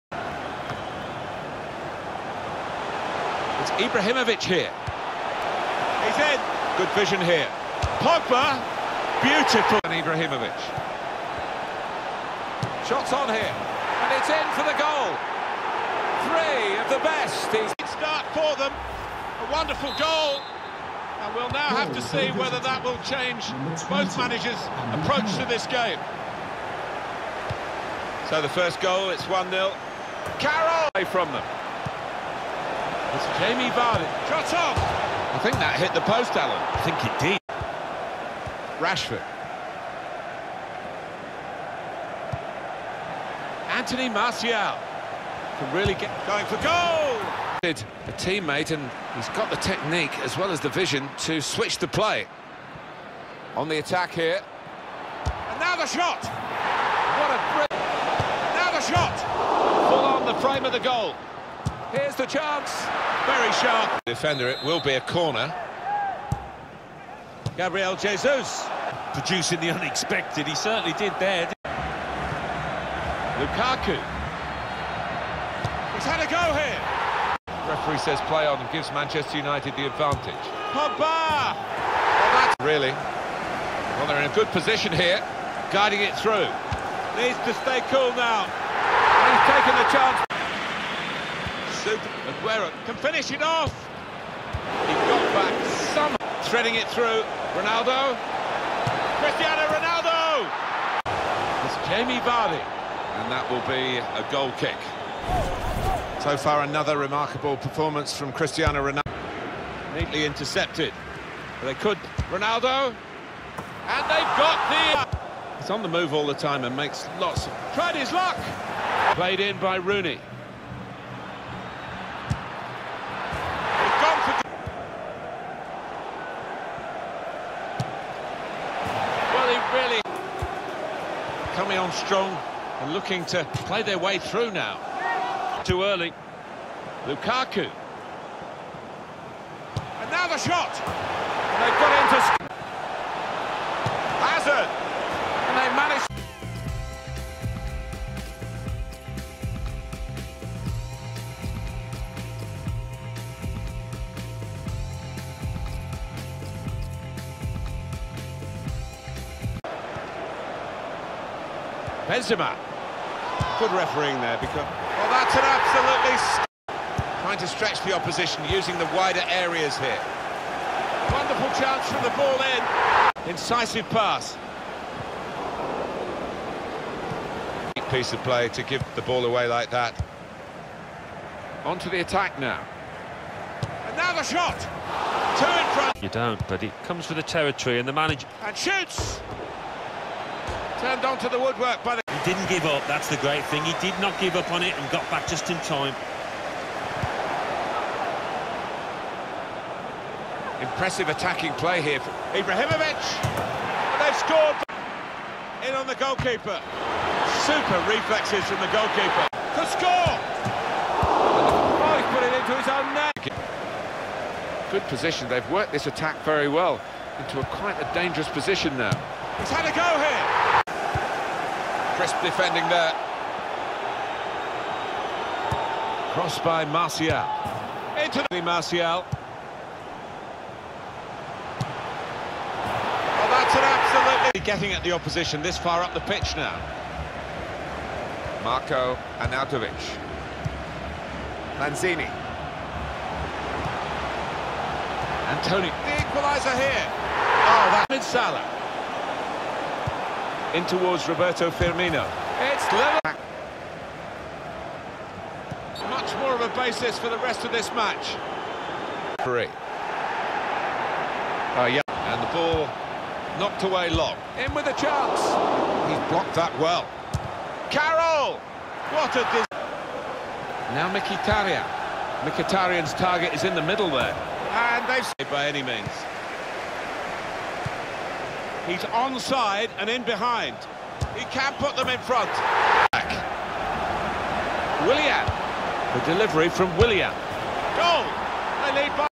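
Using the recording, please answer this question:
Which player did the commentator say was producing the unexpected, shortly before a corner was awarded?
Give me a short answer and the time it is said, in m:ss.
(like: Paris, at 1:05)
Gabriel Jesus, at 1:07.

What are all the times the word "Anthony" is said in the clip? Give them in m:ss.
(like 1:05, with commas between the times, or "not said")
0:43.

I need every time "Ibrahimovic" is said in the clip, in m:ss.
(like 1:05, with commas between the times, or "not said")
0:03, 0:10, 3:22.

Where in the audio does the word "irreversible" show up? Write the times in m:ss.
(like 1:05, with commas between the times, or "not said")
not said.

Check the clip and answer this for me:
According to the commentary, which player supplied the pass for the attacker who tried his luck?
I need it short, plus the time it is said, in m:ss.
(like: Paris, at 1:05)
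Rooney, at 1:59.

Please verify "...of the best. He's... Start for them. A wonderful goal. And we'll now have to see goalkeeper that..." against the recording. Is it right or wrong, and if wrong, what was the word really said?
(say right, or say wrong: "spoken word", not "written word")
wrong: "whether", not "goalkeeper".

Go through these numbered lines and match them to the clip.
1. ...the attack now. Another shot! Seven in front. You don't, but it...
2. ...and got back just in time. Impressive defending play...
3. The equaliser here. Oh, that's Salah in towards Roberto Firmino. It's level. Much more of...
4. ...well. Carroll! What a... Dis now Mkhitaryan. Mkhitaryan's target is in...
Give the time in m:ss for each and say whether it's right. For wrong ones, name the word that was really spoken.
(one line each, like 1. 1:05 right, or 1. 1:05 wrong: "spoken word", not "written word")
1. 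3:01 wrong: "Two", not "Seven"
2. 3:14 wrong: "attacking", not "defending"
3. 4:05 right
4. 4:26 right.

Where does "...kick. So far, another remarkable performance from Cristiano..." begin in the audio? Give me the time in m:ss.
1:44.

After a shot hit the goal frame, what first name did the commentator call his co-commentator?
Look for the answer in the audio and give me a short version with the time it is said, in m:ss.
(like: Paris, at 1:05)
Alan, at 0:36.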